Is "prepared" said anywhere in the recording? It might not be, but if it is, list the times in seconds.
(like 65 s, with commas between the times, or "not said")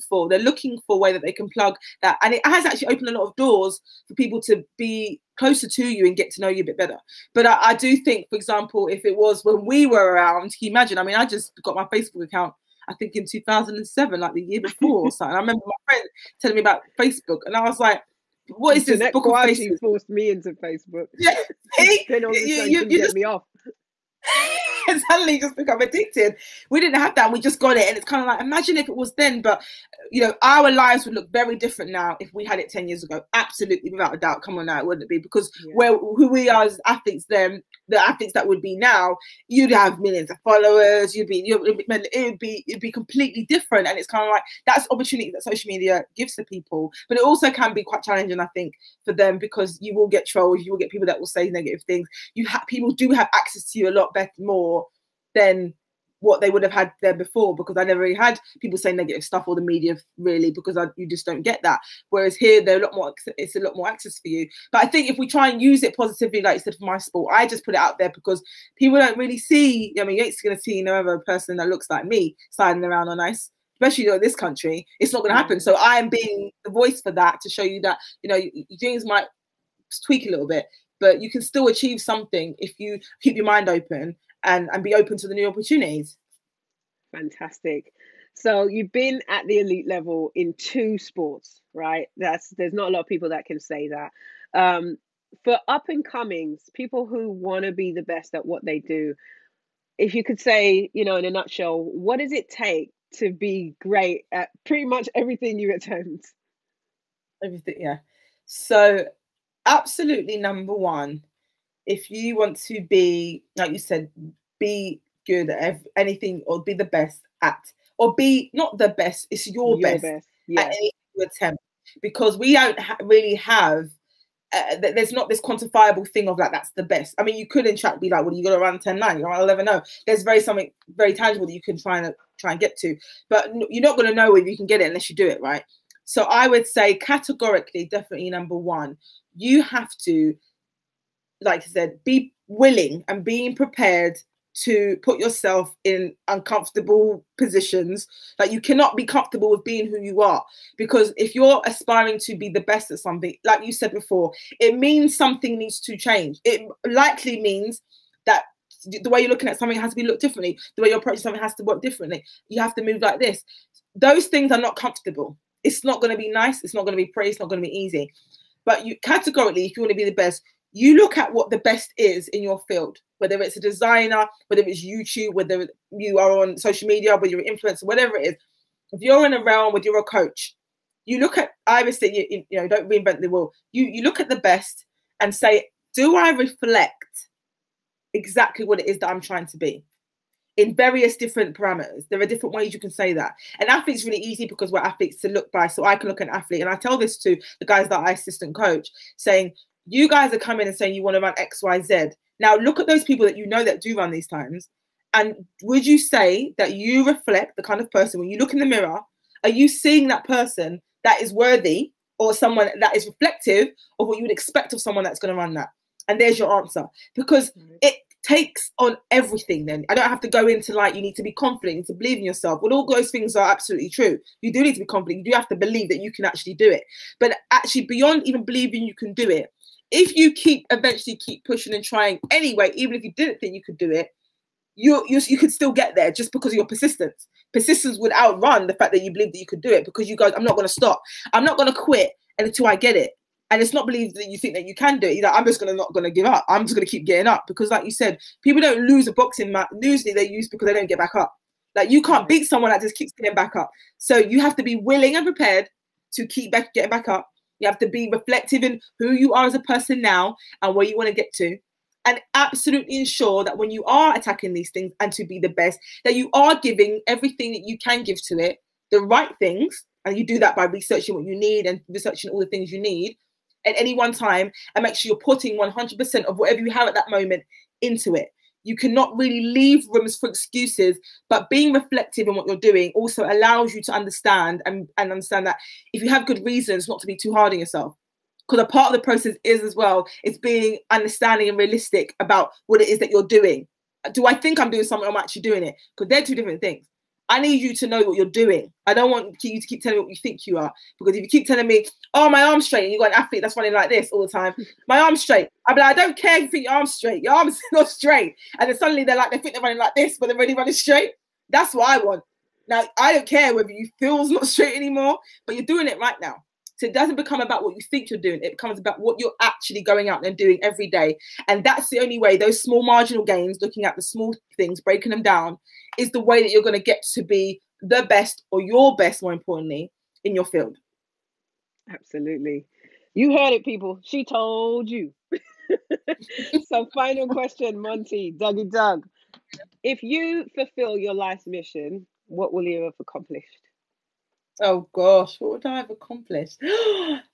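143 s, 255 s.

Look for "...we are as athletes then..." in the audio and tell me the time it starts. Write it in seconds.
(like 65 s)
36 s.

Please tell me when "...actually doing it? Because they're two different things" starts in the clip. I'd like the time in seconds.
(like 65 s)
295 s.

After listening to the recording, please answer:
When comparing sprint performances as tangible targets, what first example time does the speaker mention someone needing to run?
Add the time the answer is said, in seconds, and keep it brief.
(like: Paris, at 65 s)
10.9, at 128 s.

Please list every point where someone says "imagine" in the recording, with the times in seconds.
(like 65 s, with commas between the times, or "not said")
10 s, 28 s.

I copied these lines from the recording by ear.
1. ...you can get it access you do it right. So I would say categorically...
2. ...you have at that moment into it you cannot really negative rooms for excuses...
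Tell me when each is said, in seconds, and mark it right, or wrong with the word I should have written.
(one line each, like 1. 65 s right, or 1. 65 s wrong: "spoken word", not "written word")
1. 134 s wrong: "unless", not "access"
2. 276 s wrong: "leave", not "negative".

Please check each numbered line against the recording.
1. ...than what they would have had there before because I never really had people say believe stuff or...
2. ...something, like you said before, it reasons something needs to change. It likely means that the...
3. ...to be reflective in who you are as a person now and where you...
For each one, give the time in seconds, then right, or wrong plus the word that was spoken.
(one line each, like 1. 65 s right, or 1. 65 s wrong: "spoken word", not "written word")
1. 55 s wrong: "negative", not "believe"
2. 152 s wrong: "means", not "reasons"
3. 257 s right.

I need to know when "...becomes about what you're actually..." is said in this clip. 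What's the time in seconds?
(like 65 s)
318 s.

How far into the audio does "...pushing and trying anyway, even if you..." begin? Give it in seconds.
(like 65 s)
231 s.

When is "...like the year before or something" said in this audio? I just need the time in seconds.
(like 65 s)
14 s.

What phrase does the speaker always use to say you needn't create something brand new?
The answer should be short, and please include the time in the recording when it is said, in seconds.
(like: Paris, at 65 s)
Don't reinvent the wheel, at 182 s.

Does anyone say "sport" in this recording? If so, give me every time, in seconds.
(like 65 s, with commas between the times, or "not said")
66 s, 90 s.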